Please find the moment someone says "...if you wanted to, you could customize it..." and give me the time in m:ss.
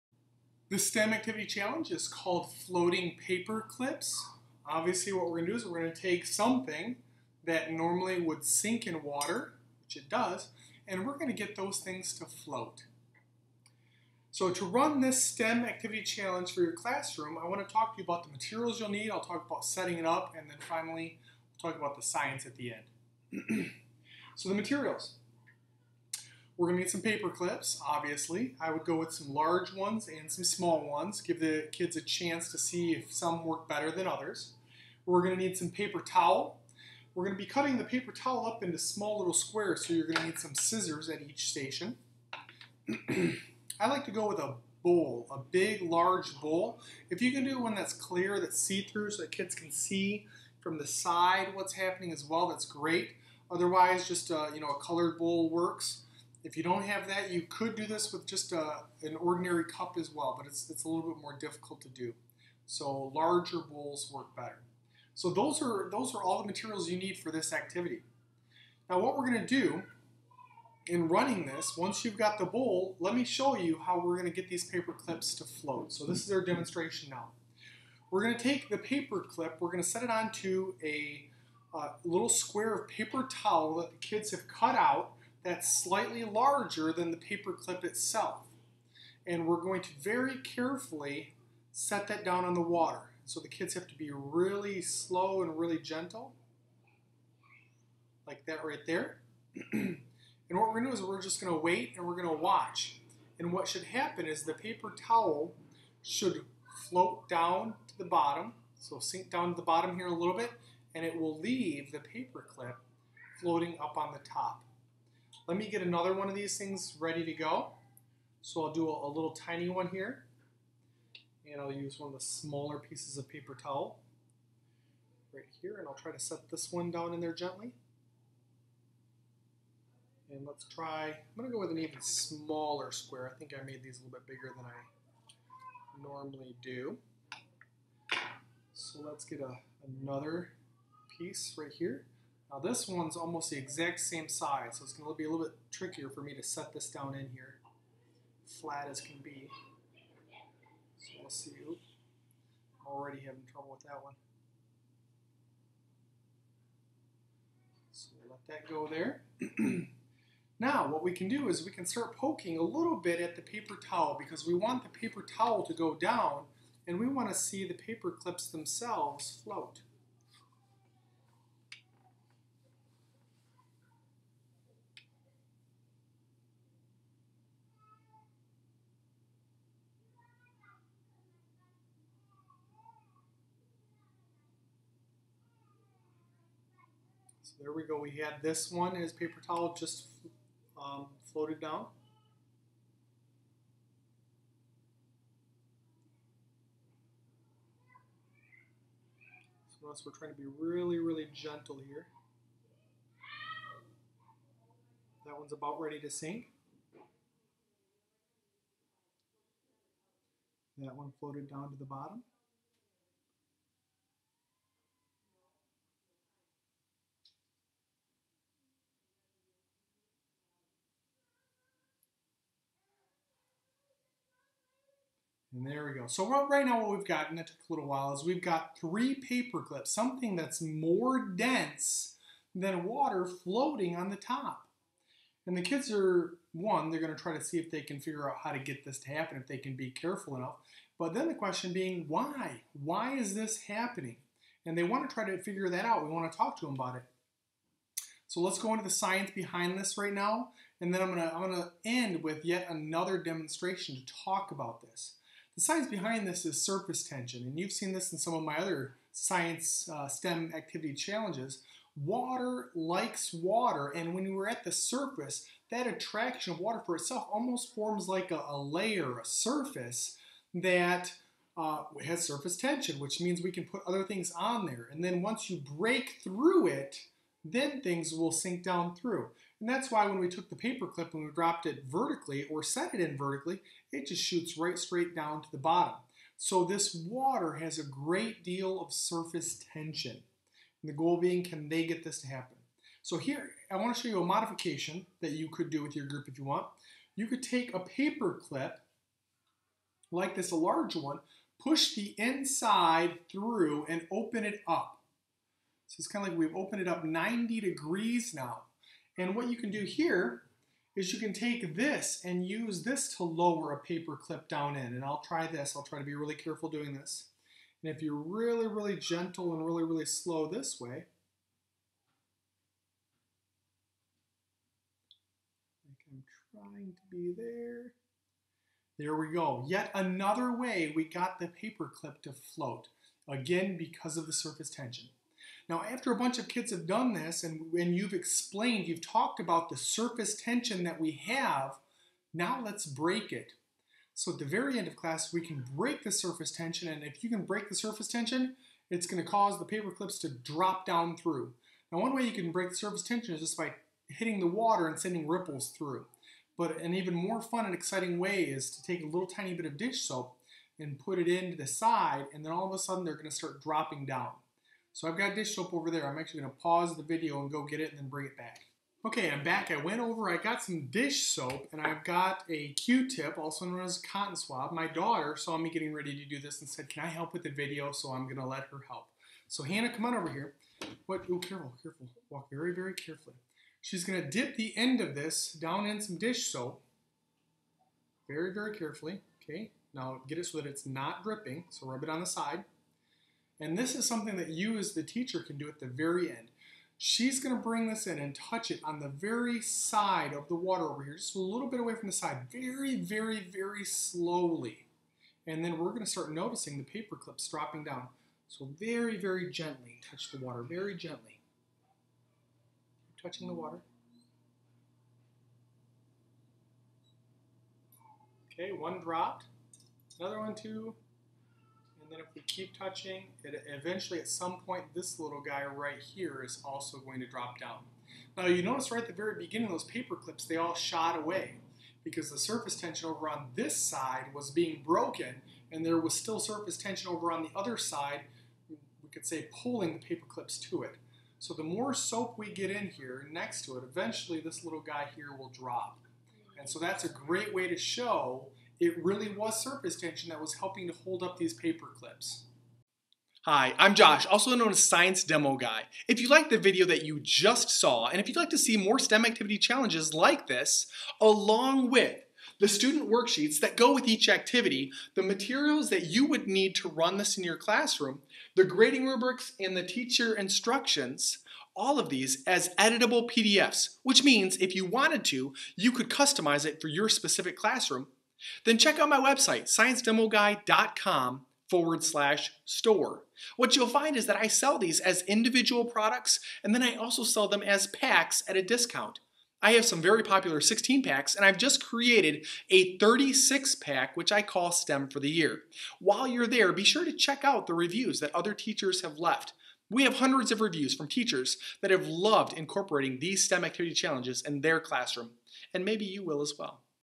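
7:54.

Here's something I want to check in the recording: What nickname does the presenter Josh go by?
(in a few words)
Science Demo Guy.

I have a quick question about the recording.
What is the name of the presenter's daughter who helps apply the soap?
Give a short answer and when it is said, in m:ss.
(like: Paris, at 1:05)
Hannah, at 6:19.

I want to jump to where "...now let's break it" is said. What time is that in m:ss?
5:42.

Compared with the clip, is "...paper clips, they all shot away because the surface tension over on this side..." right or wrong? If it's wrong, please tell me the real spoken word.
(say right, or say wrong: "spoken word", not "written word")
right.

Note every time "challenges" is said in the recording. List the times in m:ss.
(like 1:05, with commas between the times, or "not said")
0:01, 0:16, 4:20, 7:39, 8:23.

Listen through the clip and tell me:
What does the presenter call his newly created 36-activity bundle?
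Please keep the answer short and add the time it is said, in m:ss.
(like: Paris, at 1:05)
STEM for the Year, at 8:14.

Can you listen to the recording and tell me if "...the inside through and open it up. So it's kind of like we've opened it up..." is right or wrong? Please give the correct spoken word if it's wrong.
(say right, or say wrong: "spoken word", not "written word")
right.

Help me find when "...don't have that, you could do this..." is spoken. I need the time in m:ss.
0:56.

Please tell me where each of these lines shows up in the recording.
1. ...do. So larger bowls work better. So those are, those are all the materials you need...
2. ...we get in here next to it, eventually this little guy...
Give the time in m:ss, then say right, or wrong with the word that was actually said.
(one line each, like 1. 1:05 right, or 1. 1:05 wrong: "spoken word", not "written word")
1. 1:01 right
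2. 7:22 right.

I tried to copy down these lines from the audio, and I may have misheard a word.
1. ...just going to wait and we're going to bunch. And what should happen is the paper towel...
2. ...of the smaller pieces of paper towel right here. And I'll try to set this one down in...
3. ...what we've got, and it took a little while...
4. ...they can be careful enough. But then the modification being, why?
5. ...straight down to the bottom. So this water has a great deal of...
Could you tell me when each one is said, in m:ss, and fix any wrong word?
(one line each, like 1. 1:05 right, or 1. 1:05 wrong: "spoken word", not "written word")
1. 1:41 wrong: "watch", not "bunch"
2. 2:02 right
3. 3:46 right
4. 3:59 wrong: "question", not "modification"
5. 4:44 right.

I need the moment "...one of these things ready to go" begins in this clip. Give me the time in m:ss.
1:56.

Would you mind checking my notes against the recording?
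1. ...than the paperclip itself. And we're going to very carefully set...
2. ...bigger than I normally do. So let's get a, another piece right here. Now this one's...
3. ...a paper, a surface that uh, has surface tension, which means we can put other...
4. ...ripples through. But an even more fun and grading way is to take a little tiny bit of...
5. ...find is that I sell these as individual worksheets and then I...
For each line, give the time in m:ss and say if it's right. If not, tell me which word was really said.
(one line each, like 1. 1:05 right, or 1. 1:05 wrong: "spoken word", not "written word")
1. 1:26 right
2. 2:14 right
3. 4:28 wrong: "layer", not "paper"
4. 5:55 wrong: "exciting", not "grading"
5. 8:03 wrong: "products", not "worksheets".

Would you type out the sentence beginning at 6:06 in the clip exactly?
I'm actually going to pause the video and go get it and then bring it back.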